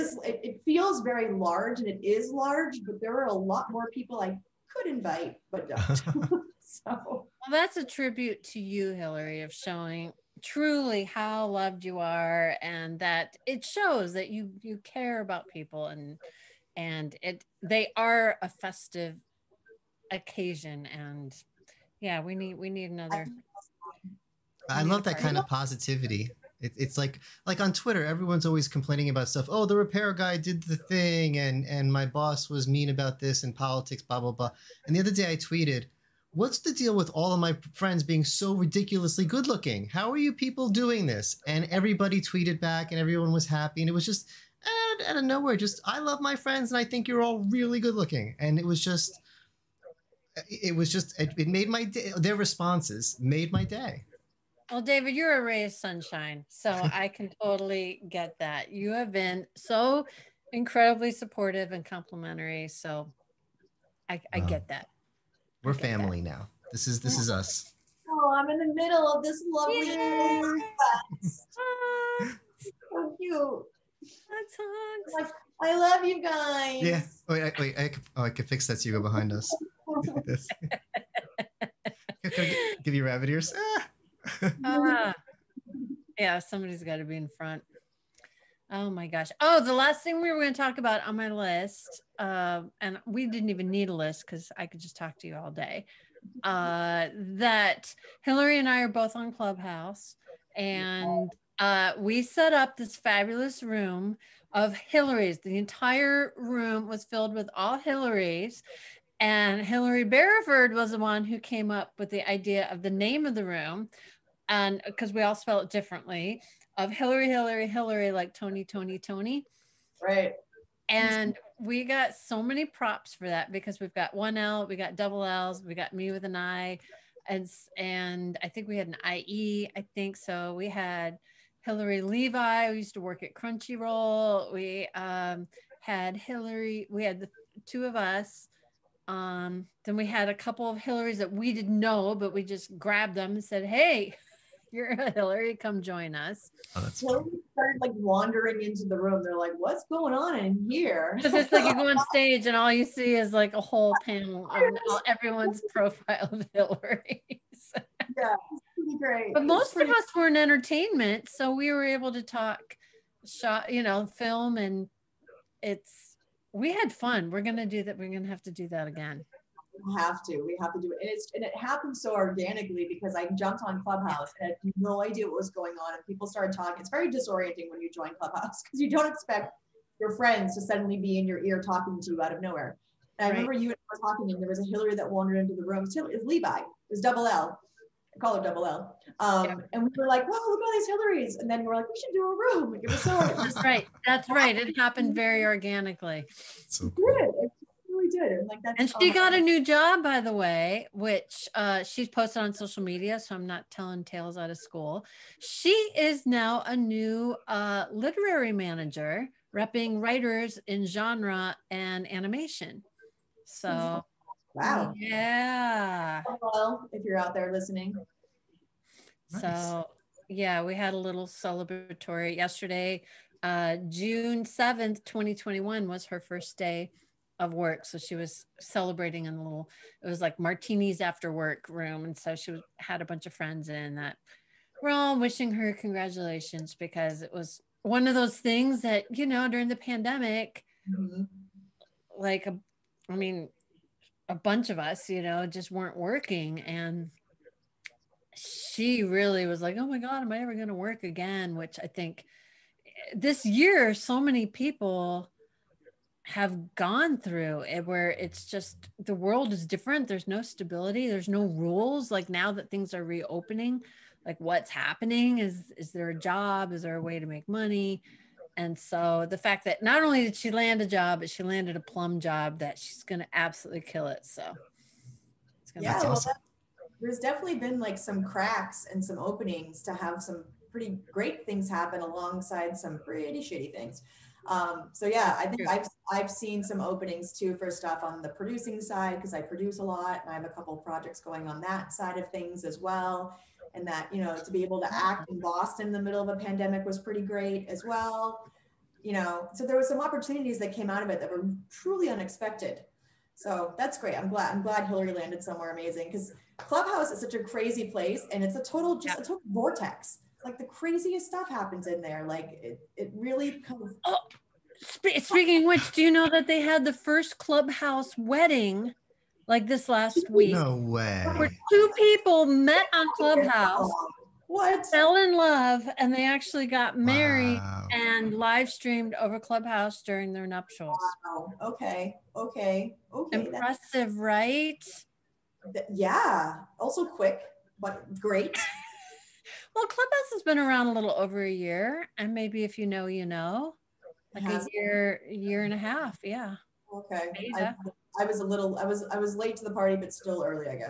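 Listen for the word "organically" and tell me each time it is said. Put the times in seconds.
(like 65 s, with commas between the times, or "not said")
172 s, 195 s.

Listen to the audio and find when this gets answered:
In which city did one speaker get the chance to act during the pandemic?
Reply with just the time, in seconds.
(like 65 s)
295 s.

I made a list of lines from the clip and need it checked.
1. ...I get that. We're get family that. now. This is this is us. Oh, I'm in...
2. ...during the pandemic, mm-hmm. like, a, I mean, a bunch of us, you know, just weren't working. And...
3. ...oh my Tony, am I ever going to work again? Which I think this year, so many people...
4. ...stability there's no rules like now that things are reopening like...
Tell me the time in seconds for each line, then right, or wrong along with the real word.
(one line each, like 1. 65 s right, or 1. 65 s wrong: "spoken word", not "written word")
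1. 64 s right
2. 239 s right
3. 249 s wrong: "God", not "Tony"
4. 260 s right.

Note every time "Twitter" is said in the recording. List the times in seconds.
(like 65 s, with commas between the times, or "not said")
27 s.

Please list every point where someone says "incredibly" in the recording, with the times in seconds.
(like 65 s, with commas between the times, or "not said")
60 s.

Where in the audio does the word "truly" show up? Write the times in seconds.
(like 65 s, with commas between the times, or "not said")
10 s, 301 s.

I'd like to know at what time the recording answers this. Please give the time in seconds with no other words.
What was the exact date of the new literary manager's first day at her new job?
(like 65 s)
223 s.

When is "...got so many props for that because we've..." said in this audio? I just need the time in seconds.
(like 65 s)
121 s.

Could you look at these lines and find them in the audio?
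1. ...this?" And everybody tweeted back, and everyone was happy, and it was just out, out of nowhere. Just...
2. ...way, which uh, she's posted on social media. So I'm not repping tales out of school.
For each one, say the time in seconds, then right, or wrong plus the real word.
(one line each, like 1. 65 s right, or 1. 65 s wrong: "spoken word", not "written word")
1. 41 s right
2. 200 s wrong: "telling", not "repping".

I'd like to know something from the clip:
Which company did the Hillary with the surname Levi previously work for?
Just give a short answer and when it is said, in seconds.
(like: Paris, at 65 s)
Crunchyroll, at 133 s.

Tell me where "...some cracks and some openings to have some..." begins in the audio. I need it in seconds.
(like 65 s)
277 s.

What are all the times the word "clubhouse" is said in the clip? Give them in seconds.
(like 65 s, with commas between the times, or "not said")
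99 s, 173 s, 178 s, 306 s, 317 s, 323 s, 329 s, 339 s.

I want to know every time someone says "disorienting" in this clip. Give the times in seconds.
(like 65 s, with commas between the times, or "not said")
177 s.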